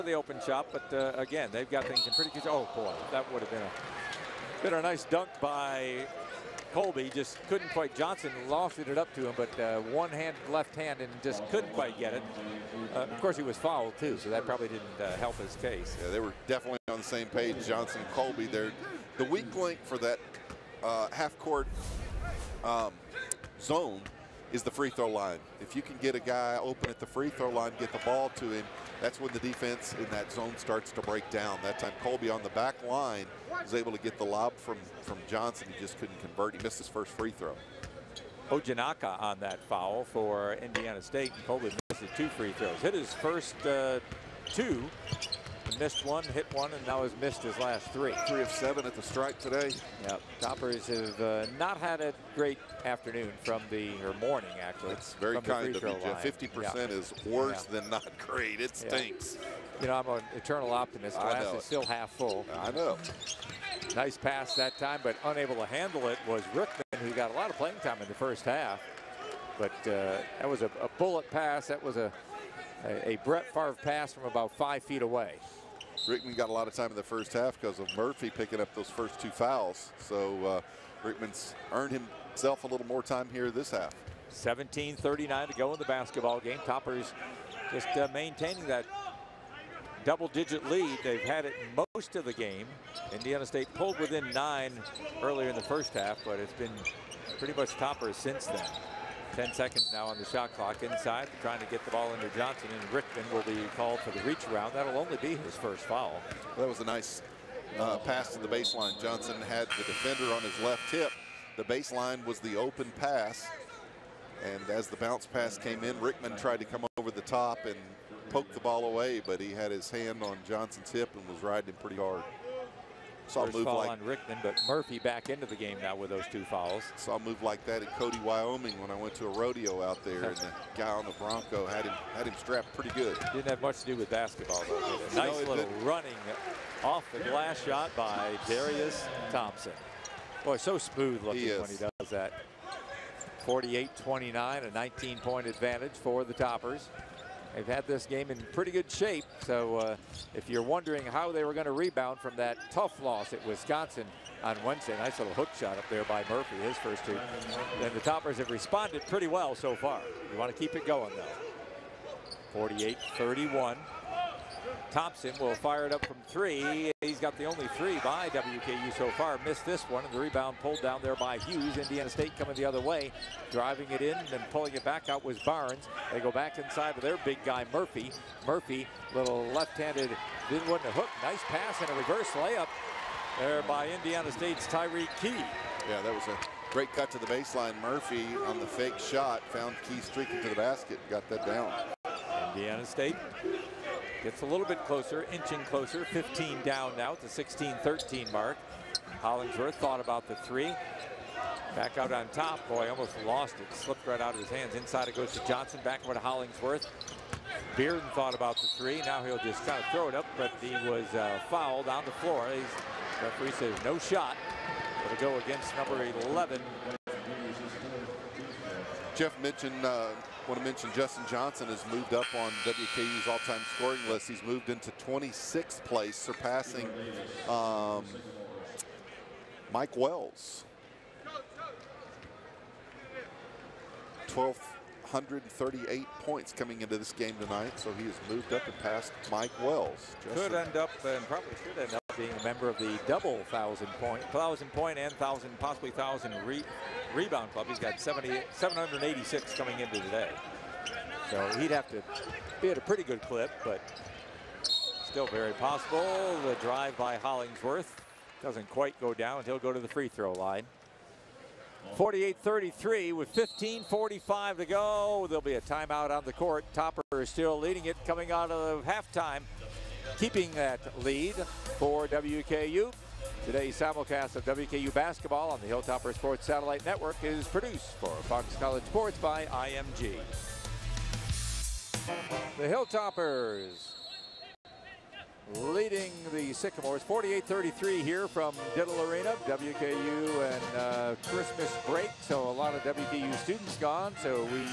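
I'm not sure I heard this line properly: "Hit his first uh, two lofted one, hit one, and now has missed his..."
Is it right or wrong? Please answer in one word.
wrong.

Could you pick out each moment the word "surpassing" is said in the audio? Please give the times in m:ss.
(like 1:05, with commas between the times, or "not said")
3:46.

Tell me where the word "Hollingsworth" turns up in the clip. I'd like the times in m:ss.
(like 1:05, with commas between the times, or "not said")
3:19, 3:26, 4:17.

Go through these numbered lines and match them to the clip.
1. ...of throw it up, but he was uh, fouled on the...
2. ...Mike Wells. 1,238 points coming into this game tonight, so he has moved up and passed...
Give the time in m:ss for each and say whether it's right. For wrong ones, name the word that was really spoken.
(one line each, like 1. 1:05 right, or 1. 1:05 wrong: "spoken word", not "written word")
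1. 3:29 right
2. 3:49 right.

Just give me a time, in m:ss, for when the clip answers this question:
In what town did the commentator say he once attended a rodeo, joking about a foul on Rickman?
2:07.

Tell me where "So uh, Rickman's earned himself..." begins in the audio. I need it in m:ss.
1:19.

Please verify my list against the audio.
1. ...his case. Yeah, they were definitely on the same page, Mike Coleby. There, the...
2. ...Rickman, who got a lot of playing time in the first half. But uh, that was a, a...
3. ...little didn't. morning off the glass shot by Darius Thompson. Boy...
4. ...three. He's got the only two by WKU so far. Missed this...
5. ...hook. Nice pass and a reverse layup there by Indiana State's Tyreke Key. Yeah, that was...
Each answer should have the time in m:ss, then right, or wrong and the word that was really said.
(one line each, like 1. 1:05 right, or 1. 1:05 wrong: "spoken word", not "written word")
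1. 0:15 wrong: "Johnson", not "Mike"
2. 1:06 right
3. 2:15 wrong: "running", not "morning"
4. 2:46 wrong: "three", not "two"
5. 3:00 right.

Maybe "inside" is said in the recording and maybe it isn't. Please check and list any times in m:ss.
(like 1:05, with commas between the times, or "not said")
1:40, 2:56, 3:24.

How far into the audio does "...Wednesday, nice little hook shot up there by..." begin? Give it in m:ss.
2:34.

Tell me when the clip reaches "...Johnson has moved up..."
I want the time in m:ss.
3:41.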